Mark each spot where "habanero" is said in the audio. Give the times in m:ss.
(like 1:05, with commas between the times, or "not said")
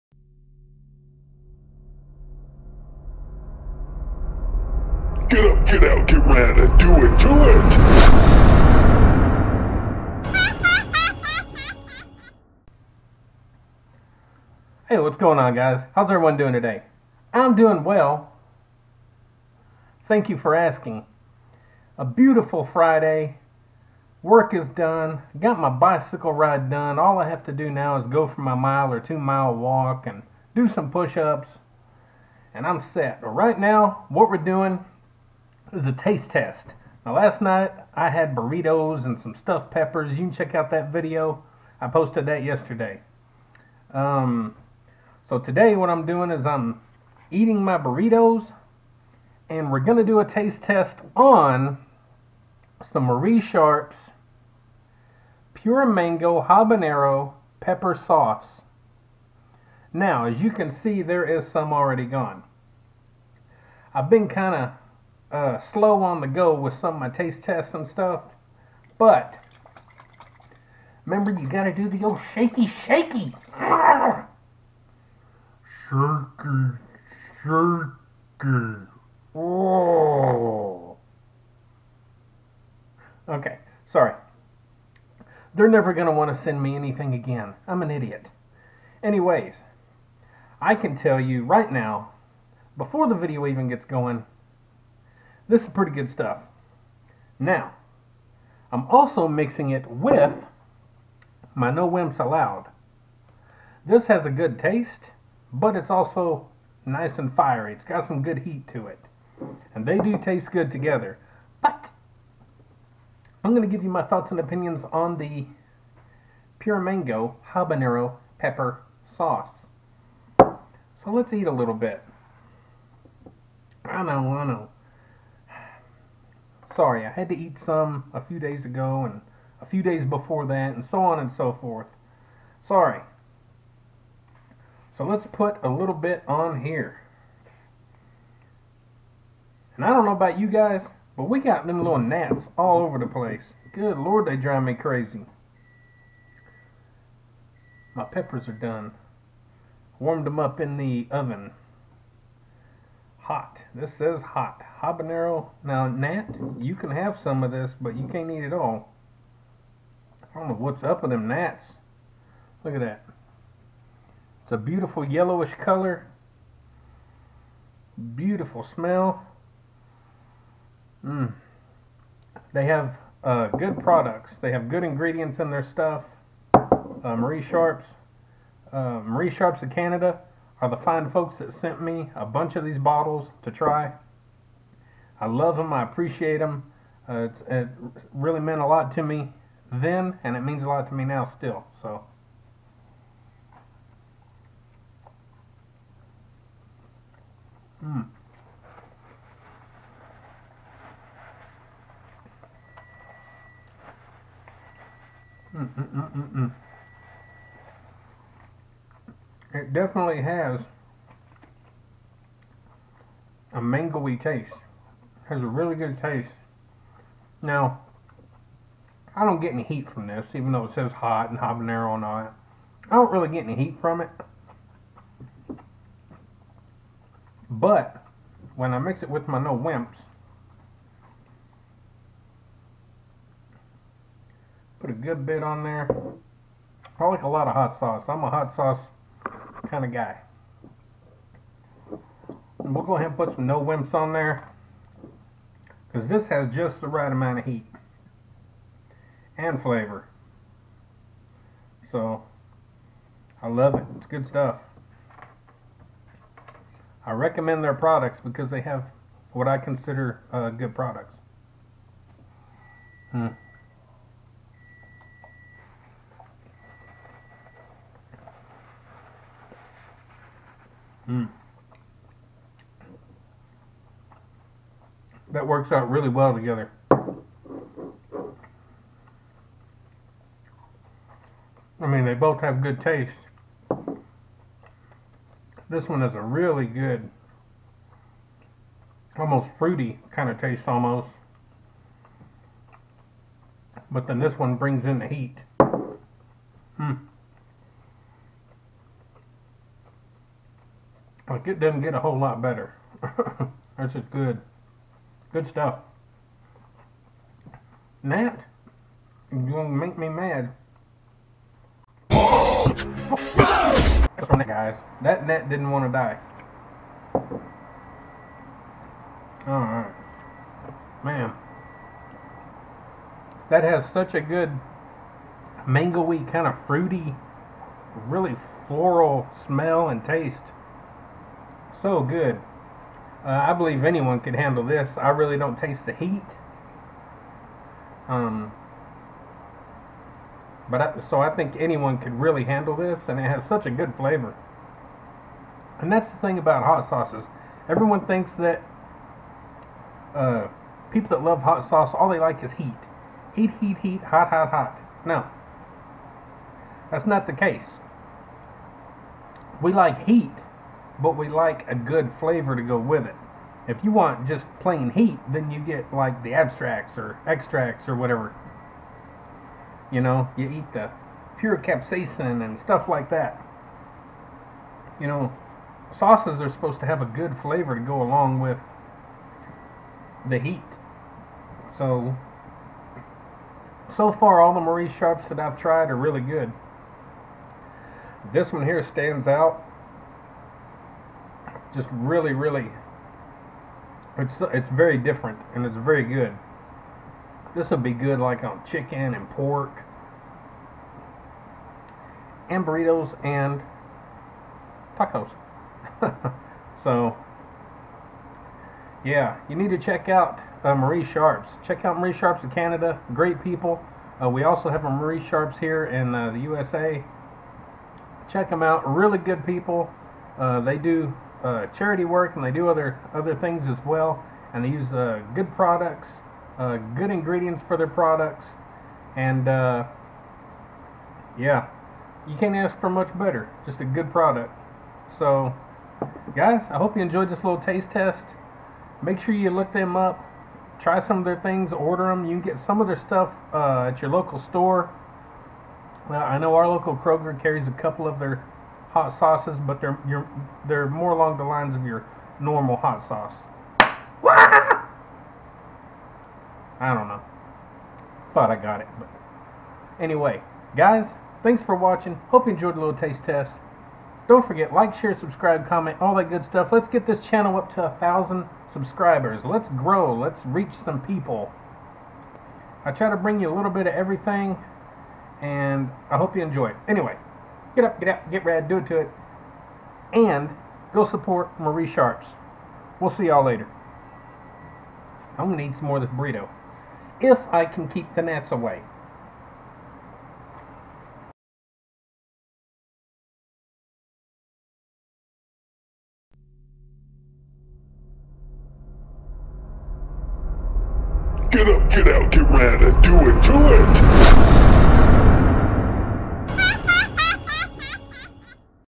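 0:56, 1:57, 2:34, 3:41.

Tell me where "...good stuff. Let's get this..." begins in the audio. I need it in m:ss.
7:46.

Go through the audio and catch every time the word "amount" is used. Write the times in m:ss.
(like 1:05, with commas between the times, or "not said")
4:07.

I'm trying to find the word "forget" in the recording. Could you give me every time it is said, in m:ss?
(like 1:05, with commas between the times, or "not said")
7:44.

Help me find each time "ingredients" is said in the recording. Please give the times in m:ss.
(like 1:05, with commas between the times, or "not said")
2:54, 7:07.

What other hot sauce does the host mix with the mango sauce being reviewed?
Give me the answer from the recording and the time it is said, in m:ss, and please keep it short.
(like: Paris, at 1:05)
No Wimps Allowed, at 1:41.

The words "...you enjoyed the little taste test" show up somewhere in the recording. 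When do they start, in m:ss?
7:42.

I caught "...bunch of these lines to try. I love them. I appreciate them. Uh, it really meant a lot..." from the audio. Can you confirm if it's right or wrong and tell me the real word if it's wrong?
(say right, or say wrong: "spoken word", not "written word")
wrong: "bottles", not "lines".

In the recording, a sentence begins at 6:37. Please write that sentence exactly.
This would be good like on chicken and pork and burritos and tacos.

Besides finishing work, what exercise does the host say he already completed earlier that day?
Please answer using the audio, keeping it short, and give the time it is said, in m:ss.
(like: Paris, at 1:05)
bicycle ride, at 0:25.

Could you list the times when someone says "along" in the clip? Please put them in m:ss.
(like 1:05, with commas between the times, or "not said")
6:18, 7:31.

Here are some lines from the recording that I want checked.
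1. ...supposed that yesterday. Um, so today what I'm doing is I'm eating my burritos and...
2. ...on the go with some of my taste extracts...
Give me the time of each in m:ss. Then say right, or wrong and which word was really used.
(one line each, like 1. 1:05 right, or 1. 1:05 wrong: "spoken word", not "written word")
1. 0:41 wrong: "posted", not "supposed"
2. 1:06 wrong: "tests", not "extracts".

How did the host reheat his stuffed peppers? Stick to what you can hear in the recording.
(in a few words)
in the oven.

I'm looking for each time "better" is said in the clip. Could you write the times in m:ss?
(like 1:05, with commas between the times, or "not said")
5:02, 7:13.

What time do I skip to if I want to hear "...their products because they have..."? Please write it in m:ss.
4:17.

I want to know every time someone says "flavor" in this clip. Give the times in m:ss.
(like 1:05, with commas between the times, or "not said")
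4:09, 5:43, 6:02, 6:17.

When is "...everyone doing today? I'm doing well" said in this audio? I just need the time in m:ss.
0:16.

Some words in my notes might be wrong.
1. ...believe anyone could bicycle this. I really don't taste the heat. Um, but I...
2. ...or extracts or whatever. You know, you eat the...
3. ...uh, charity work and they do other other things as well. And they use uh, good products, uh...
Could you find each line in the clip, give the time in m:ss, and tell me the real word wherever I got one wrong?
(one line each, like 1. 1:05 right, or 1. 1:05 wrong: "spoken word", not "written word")
1. 5:33 wrong: "handle", not "bicycle"
2. 6:06 right
3. 7:01 right.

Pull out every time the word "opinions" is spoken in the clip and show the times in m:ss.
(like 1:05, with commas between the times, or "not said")
1:54.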